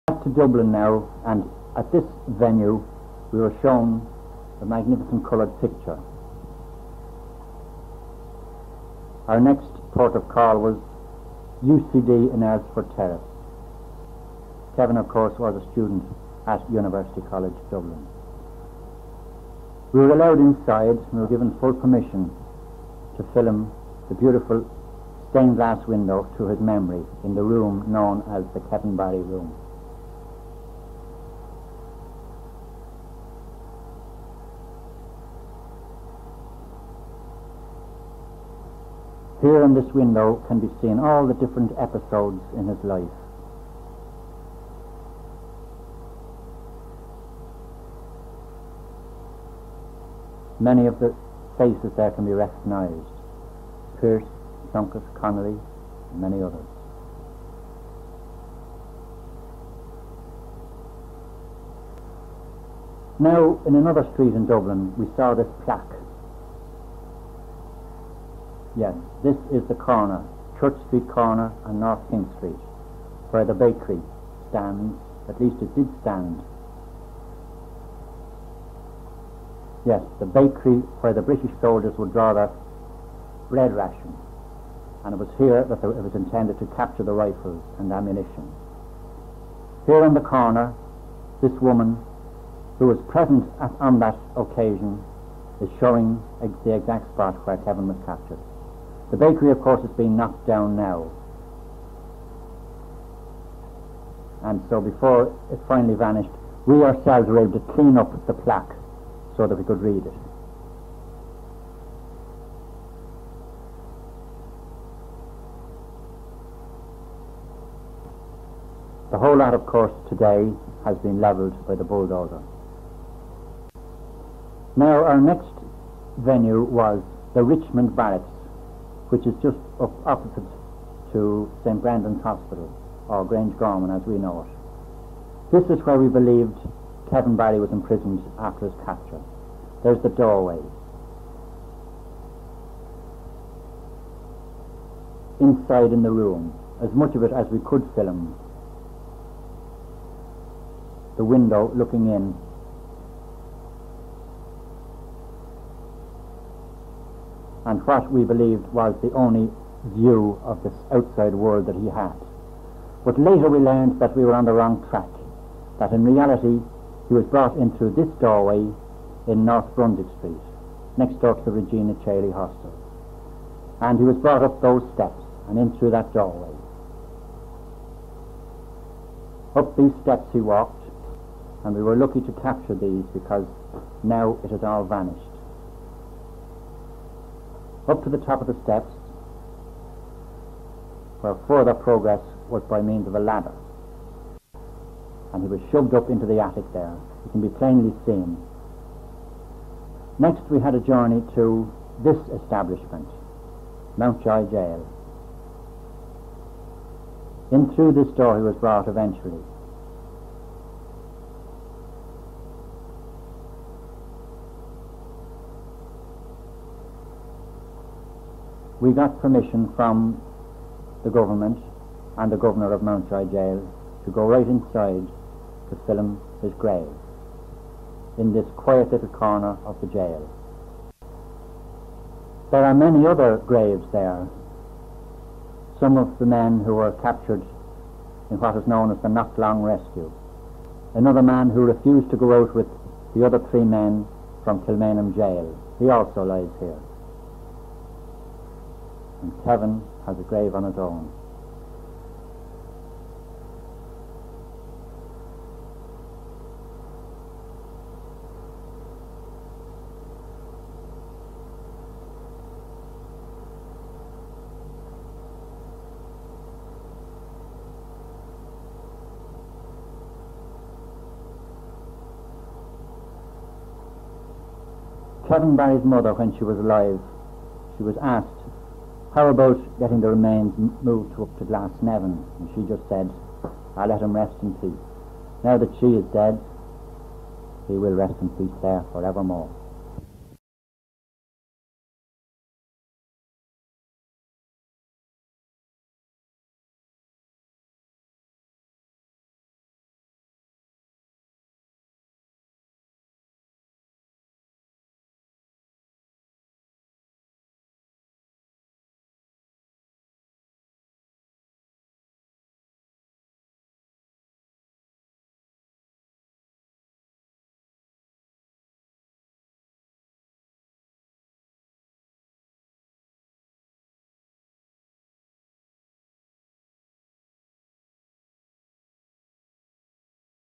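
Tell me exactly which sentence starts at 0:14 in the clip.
Kevin, of course, was a student at University College Dublin.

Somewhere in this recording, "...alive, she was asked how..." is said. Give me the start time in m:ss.
4:36.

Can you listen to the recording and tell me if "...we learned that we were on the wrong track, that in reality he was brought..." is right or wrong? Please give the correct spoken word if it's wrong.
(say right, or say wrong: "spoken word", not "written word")
right.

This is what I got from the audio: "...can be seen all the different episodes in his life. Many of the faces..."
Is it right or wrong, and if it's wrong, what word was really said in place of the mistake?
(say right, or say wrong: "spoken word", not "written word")
right.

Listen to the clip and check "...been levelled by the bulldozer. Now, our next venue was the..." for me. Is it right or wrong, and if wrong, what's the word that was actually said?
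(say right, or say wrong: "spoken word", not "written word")
right.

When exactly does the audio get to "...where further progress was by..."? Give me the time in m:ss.
3:11.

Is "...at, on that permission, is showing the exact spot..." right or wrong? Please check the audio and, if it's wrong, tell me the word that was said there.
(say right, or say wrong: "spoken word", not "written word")
wrong: "occasion", not "permission".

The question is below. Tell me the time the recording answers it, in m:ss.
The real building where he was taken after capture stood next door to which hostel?
2:51.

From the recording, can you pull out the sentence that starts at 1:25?
And it was here that it was intended to capture the rifles and ammunition.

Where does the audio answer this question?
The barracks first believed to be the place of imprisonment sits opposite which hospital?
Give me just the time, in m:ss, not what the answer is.
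2:11.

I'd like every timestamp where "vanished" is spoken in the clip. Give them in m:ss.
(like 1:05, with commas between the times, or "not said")
1:45, 3:04.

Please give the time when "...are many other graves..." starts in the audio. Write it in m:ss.
3:52.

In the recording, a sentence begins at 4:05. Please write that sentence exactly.
He also lies here and Kevin has a grave on its own.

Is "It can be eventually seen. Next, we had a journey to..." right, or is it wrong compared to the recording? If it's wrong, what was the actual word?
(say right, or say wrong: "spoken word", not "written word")
wrong: "plainly", not "eventually".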